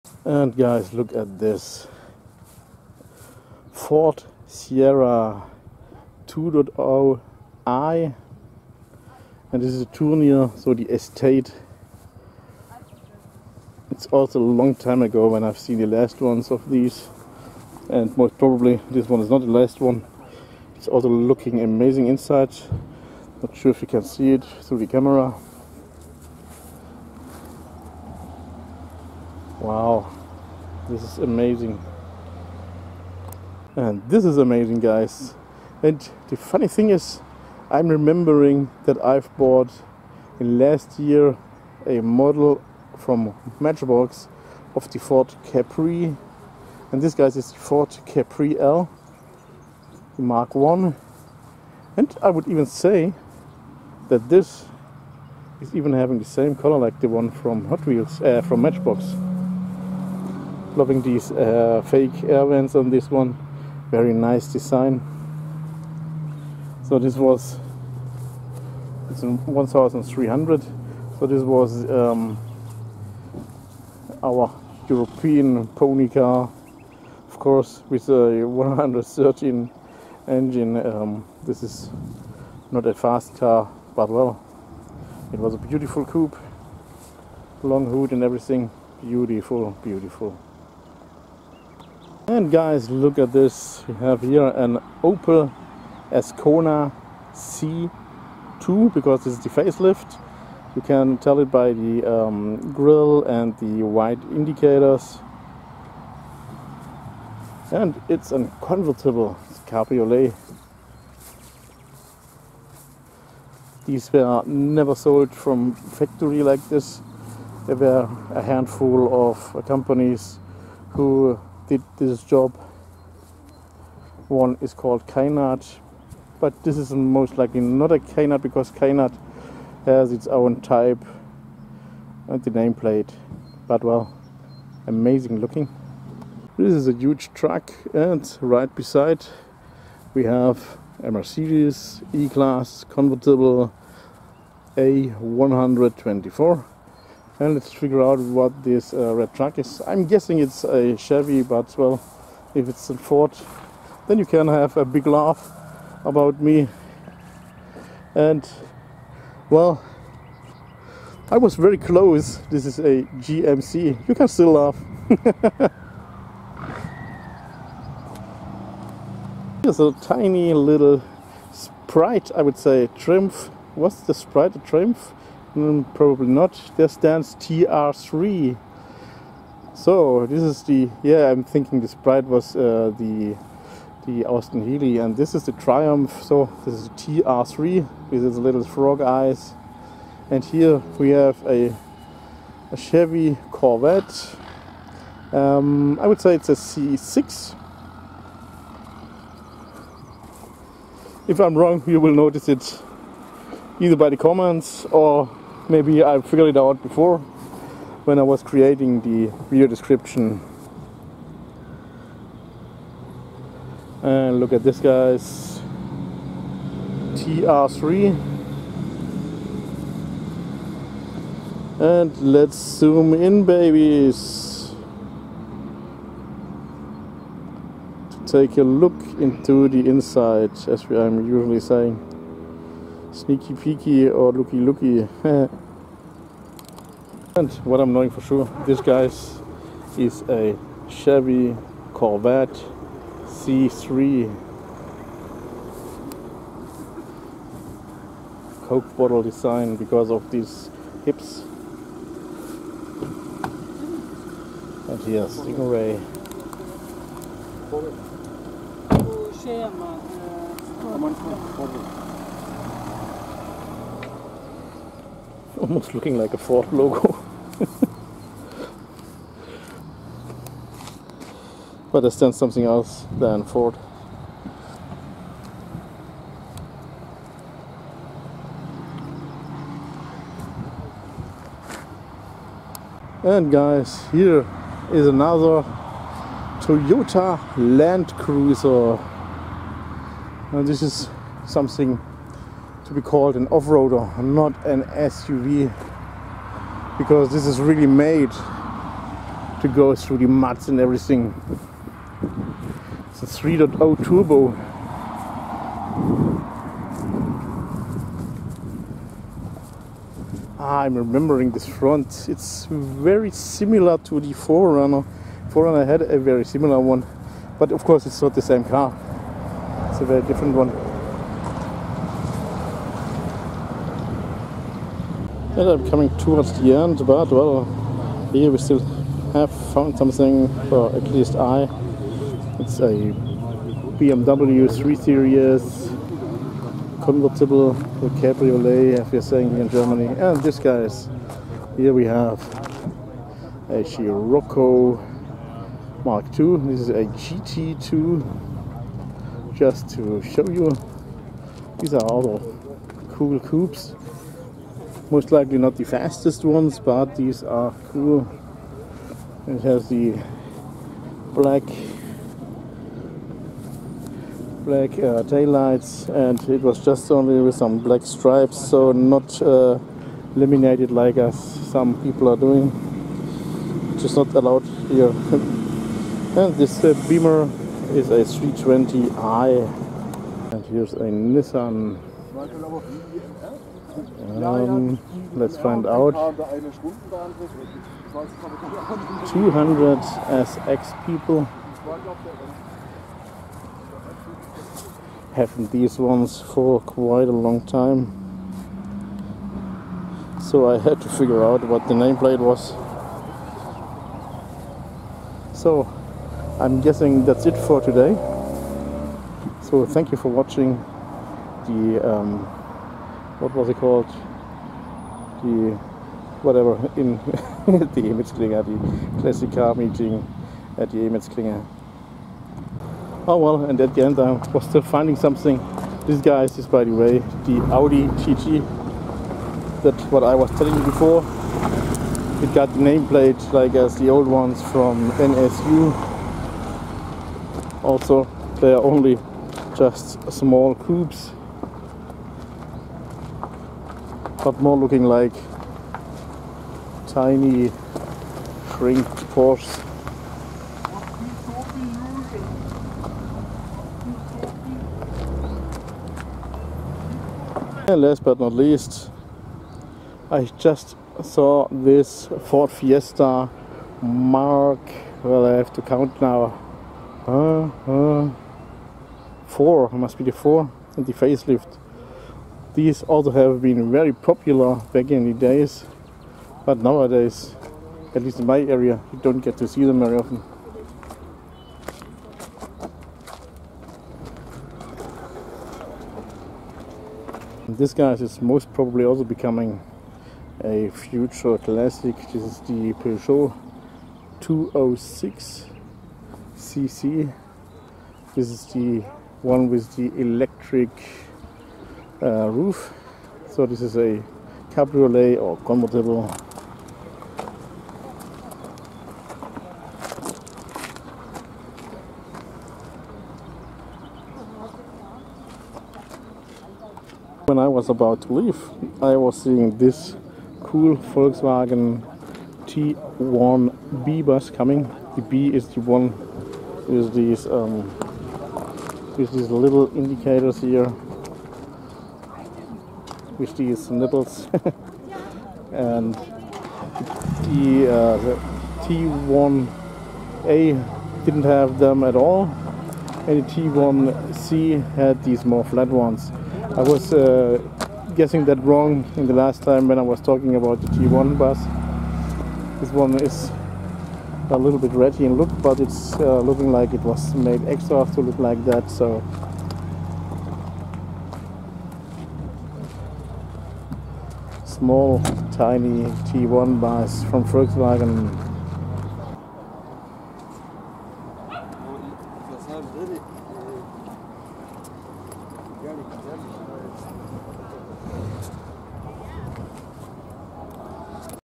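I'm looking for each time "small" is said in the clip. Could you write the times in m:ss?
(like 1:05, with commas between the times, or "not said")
7:20, 9:24.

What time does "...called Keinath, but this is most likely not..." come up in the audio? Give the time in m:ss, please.
2:04.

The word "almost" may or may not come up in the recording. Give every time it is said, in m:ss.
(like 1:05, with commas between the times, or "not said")
4:25.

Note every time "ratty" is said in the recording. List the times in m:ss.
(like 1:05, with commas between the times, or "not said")
9:14.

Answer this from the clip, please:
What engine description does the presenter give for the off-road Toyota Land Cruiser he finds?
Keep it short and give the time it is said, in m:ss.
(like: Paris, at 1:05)
3.0 turbo, at 5:03.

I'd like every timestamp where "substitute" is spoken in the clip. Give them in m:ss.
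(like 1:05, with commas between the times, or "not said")
not said.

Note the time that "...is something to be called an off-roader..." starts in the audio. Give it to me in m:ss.
4:50.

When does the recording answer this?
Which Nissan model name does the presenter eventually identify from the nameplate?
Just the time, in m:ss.
6:26.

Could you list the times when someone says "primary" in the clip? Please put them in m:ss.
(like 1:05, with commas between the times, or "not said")
not said.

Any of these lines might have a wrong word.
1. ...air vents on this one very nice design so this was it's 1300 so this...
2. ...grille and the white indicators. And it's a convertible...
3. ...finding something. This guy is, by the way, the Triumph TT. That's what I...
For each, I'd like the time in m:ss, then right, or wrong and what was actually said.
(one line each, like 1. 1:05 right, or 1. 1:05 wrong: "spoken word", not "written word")
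1. 1:02 right
2. 1:42 right
3. 7:04 wrong: "Audi", not "Triumph".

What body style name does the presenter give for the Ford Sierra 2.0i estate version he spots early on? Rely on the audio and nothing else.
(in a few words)
Tournier.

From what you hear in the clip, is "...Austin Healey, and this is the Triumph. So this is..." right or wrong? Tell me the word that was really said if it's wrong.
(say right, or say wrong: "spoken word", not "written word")
right.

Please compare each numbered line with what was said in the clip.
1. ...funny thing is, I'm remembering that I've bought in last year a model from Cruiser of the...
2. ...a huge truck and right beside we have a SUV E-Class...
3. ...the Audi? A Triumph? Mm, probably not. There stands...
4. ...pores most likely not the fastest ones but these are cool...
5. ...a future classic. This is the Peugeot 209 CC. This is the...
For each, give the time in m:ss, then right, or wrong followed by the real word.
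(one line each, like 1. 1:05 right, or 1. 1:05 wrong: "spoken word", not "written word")
1. 0:36 wrong: "Matchbox", not "Cruiser"
2. 2:16 wrong: "Mercedes", not "SUV"
3. 2:54 wrong: "Sprite", not "Audi"
4. 5:53 wrong: "coupes", not "pores"
5. 8:10 wrong: "206", not "209".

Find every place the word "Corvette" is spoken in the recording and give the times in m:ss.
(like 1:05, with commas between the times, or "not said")
3:13, 4:01.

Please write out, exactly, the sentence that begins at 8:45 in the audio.
The B is the one with these um, with these little indicators here with these nipples.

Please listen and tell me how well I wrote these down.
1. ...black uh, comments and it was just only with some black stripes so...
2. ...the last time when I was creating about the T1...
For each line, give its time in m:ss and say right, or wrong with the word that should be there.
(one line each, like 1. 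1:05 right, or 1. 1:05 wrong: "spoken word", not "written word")
1. 6:04 wrong: "taillights", not "comments"
2. 9:09 wrong: "talking", not "creating".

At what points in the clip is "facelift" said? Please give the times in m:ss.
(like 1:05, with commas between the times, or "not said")
1:39, 7:51.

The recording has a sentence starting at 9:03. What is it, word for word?
And the T1C had these more flat ones.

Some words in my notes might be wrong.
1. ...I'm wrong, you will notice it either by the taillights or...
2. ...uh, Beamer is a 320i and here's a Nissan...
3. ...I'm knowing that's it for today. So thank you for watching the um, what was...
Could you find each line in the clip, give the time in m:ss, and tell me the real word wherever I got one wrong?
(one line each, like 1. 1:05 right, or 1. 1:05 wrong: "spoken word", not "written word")
1. 3:21 wrong: "comments", not "taillights"
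2. 6:16 right
3. 6:46 wrong: "guessing", not "knowing".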